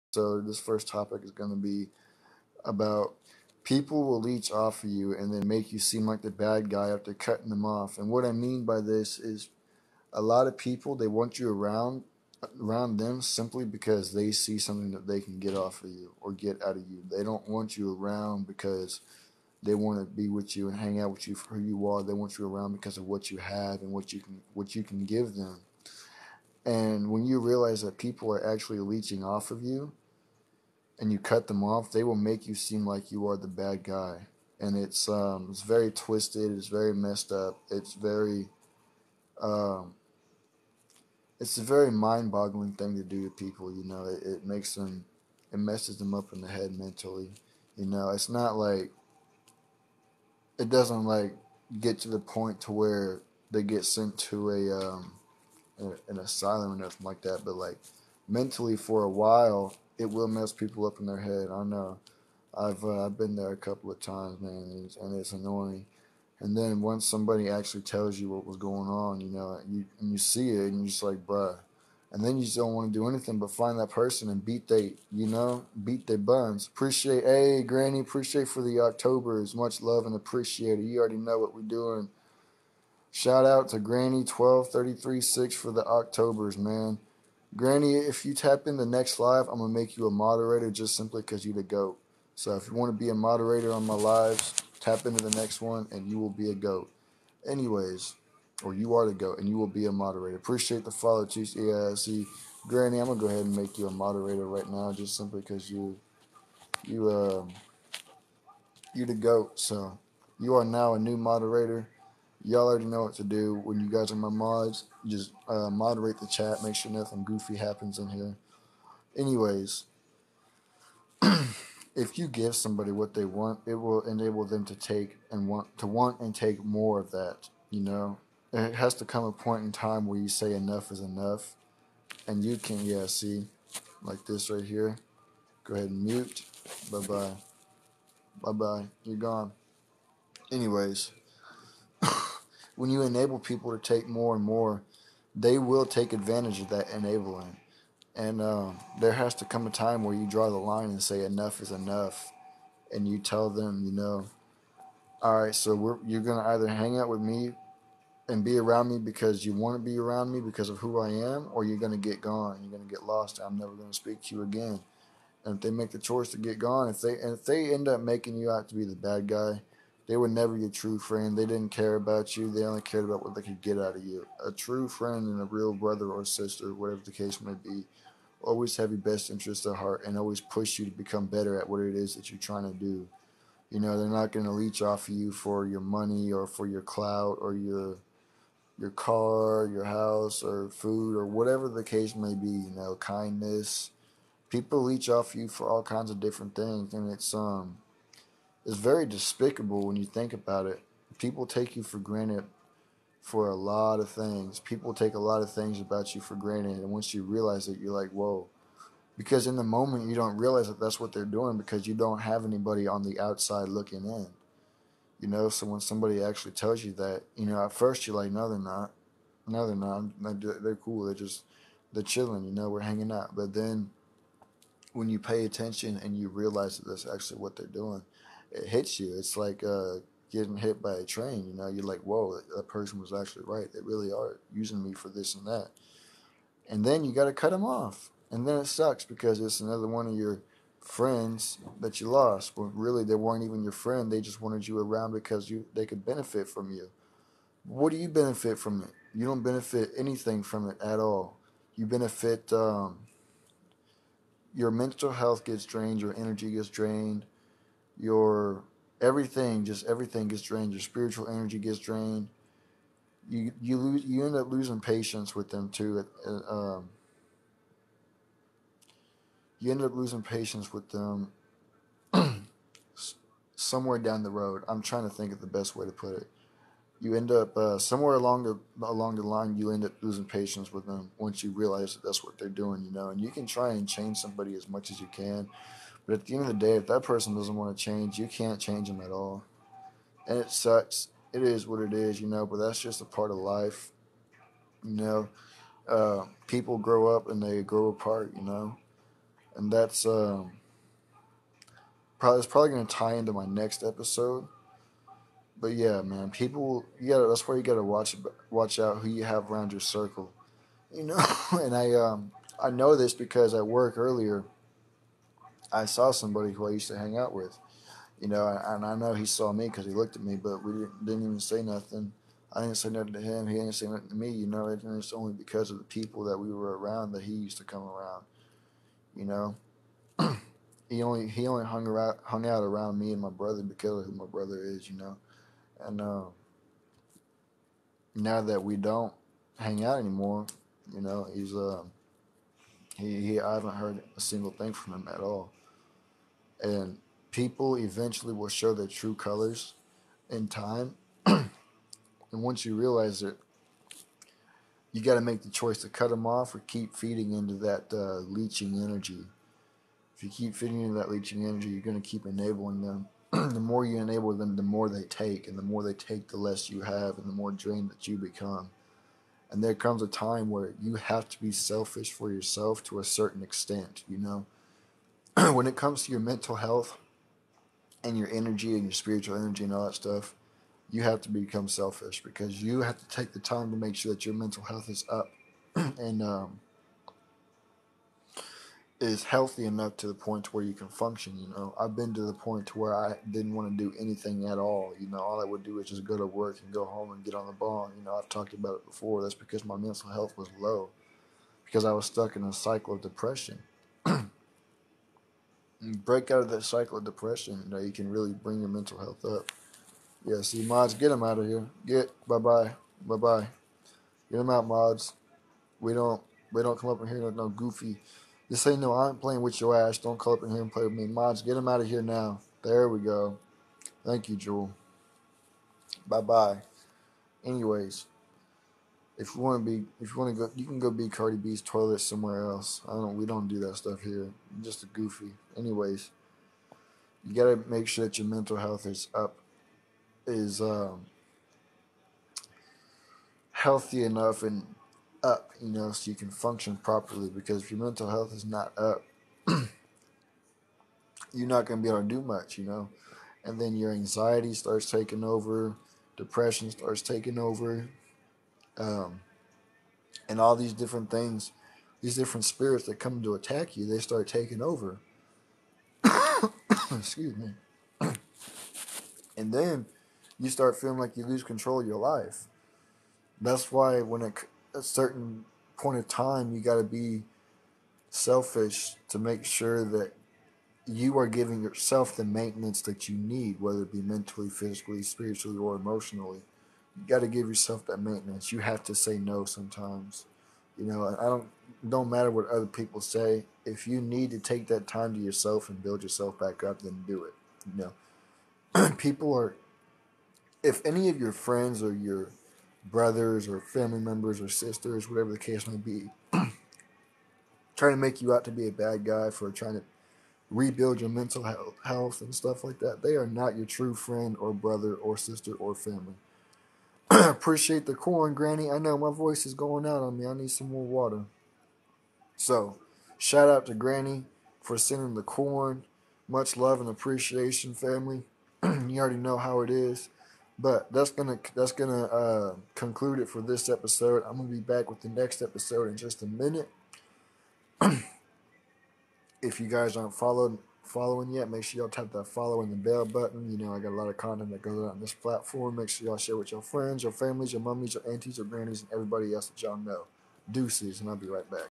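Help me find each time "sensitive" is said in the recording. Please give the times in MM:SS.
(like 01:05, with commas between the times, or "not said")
not said.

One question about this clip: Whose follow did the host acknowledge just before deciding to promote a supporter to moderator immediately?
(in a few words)
Chiefs EIC.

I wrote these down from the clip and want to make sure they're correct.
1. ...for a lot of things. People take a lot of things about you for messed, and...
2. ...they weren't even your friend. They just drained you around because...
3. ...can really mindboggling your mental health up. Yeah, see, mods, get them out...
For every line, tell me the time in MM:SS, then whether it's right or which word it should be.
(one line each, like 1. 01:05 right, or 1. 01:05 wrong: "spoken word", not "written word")
1. 03:23 wrong: "granted", not "messed"
2. 04:03 wrong: "wanted", not "drained"
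3. 06:47 wrong: "bring", not "mindboggling".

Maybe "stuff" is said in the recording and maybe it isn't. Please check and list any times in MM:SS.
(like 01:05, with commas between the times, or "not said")
06:19, 07:13, 08:32.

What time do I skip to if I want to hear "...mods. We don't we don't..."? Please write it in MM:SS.
06:54.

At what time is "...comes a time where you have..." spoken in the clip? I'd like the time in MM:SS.
06:09.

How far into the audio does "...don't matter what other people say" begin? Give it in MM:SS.
08:11.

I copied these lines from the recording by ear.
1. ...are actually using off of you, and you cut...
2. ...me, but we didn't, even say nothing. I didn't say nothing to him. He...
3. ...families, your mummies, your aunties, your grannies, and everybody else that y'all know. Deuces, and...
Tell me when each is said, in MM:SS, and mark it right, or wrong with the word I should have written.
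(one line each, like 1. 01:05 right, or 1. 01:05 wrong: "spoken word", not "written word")
1. 00:28 wrong: "leeching", not "using"
2. 05:20 right
3. 09:07 right.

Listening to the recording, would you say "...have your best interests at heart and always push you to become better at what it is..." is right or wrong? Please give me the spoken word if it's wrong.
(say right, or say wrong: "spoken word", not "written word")
right.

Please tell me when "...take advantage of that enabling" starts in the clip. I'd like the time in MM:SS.
02:25.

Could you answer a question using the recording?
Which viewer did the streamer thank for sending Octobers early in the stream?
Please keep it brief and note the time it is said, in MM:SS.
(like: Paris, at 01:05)
Granny12336, at 01:23.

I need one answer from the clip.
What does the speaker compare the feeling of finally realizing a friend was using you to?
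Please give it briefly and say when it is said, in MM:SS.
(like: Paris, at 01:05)
getting hit by a train, at 03:50.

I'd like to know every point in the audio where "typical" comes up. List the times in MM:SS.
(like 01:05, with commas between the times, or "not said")
not said.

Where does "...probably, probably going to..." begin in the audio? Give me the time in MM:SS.
05:02.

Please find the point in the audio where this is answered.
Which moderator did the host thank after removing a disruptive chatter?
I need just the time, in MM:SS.
07:04.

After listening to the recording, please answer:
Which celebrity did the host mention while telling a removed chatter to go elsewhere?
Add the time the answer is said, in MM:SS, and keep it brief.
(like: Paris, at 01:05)
Cardi B, at 07:11.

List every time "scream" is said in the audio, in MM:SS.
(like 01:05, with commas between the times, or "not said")
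not said.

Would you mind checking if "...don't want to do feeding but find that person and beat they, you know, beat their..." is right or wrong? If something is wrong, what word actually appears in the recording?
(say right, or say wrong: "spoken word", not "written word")
wrong: "anything", not "feeding".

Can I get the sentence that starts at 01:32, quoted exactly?
So if you want to be a moderator on my lives, tap into the next one and you will be a goat.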